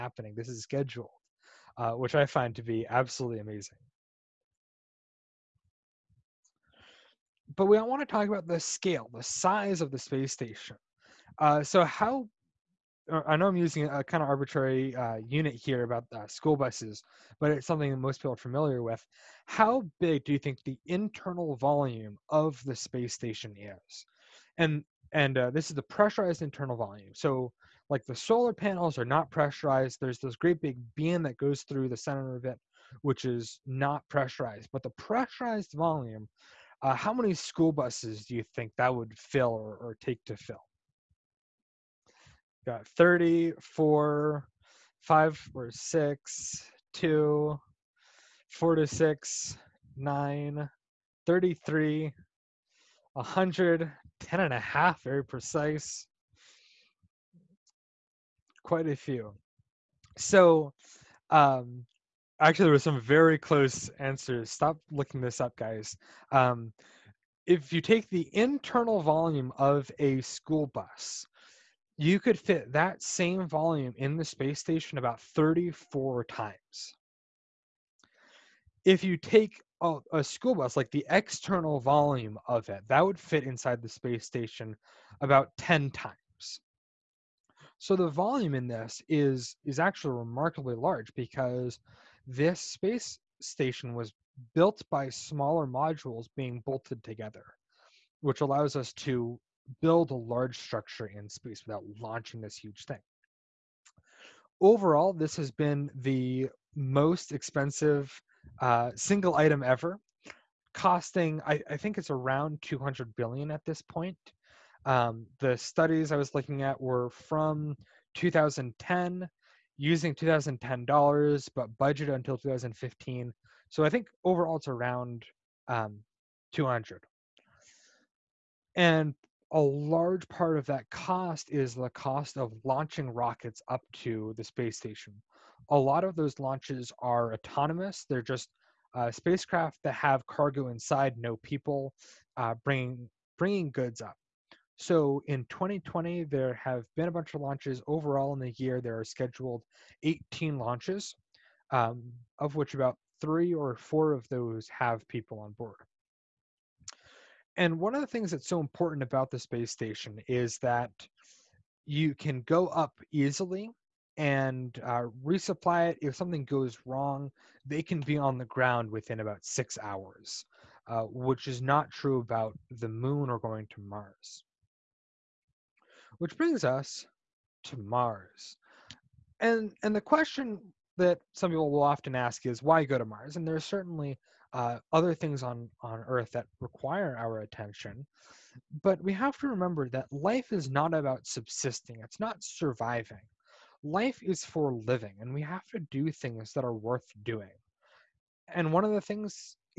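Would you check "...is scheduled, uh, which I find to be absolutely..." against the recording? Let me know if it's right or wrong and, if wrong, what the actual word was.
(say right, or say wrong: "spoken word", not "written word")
right.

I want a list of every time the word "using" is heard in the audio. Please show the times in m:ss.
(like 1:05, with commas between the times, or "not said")
0:13, 1:59.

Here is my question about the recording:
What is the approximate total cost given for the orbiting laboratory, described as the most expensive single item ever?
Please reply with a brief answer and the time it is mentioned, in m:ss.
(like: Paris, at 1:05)
200 billion, at 1:52.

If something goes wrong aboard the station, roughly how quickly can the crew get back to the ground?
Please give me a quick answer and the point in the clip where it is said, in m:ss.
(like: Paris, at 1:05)
About 6 hours, at 2:49.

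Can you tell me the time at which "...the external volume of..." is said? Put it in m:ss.
1:20.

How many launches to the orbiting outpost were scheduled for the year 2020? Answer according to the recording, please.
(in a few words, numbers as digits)
18.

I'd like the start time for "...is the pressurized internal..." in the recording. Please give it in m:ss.
0:25.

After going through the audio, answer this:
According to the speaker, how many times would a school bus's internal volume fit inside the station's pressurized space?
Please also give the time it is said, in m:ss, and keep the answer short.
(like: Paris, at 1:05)
34, at 1:14.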